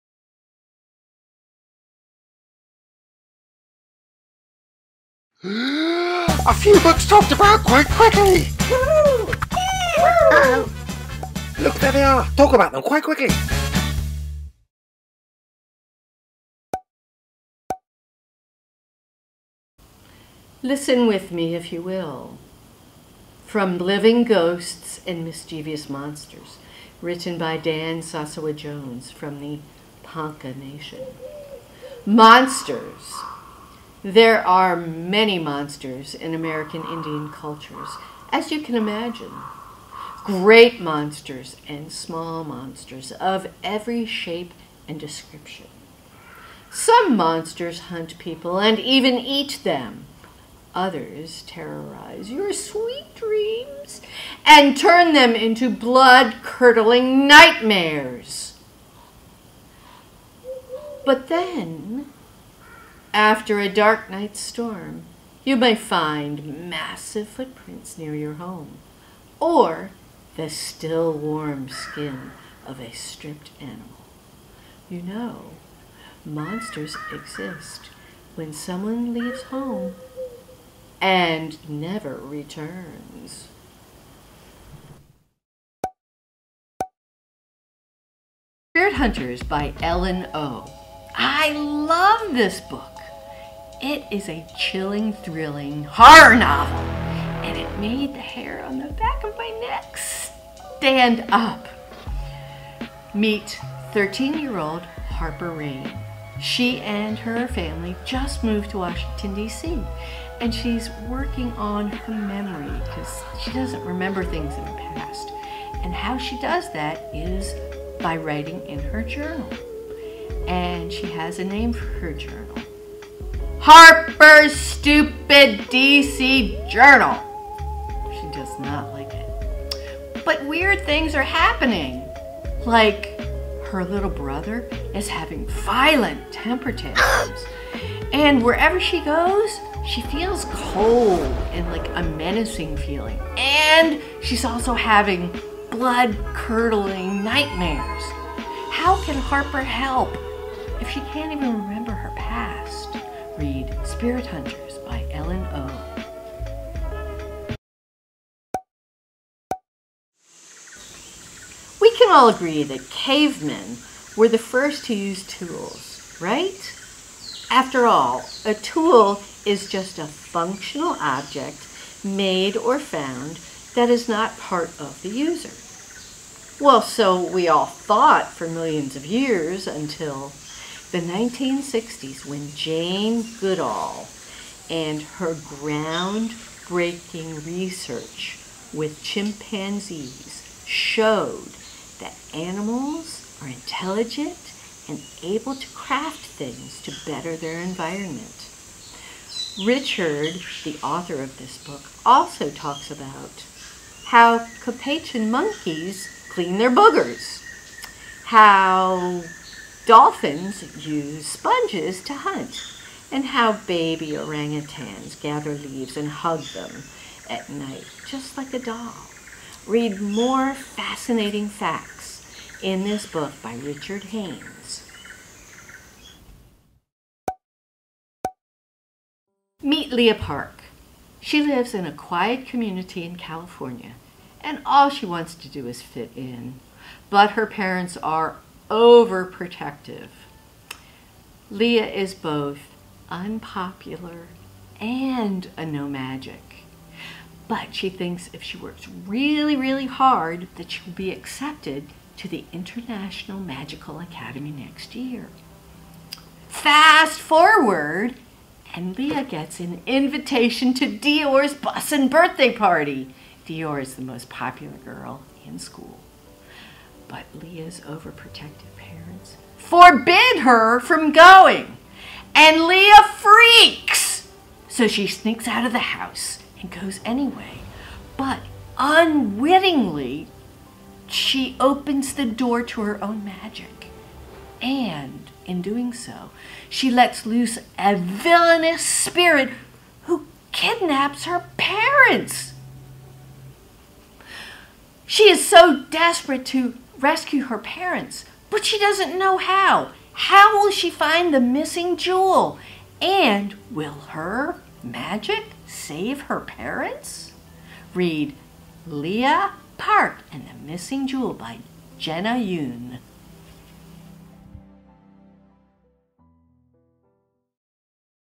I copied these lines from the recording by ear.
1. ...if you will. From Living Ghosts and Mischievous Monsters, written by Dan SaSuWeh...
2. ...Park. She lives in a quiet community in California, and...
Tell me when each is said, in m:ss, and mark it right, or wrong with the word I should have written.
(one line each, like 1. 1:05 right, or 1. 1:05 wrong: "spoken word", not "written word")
1. 0:21 right
2. 3:50 right.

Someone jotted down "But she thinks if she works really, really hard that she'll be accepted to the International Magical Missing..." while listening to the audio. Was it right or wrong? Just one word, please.
wrong.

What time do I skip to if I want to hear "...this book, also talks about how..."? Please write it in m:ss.
3:21.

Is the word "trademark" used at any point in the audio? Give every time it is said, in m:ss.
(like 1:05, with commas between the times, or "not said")
not said.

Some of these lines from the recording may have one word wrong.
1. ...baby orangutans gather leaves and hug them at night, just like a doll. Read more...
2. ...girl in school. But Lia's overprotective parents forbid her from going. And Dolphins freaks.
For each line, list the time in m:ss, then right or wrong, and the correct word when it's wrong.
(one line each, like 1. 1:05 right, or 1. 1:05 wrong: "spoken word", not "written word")
1. 3:33 right
2. 4:24 wrong: "Lia", not "Dolphins".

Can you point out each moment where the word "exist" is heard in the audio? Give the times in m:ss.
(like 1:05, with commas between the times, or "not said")
1:17.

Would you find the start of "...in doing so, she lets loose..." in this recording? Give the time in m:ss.
4:45.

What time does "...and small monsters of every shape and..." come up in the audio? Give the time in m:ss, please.
0:41.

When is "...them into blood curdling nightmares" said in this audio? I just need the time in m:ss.
0:55.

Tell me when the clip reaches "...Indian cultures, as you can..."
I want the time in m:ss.
0:36.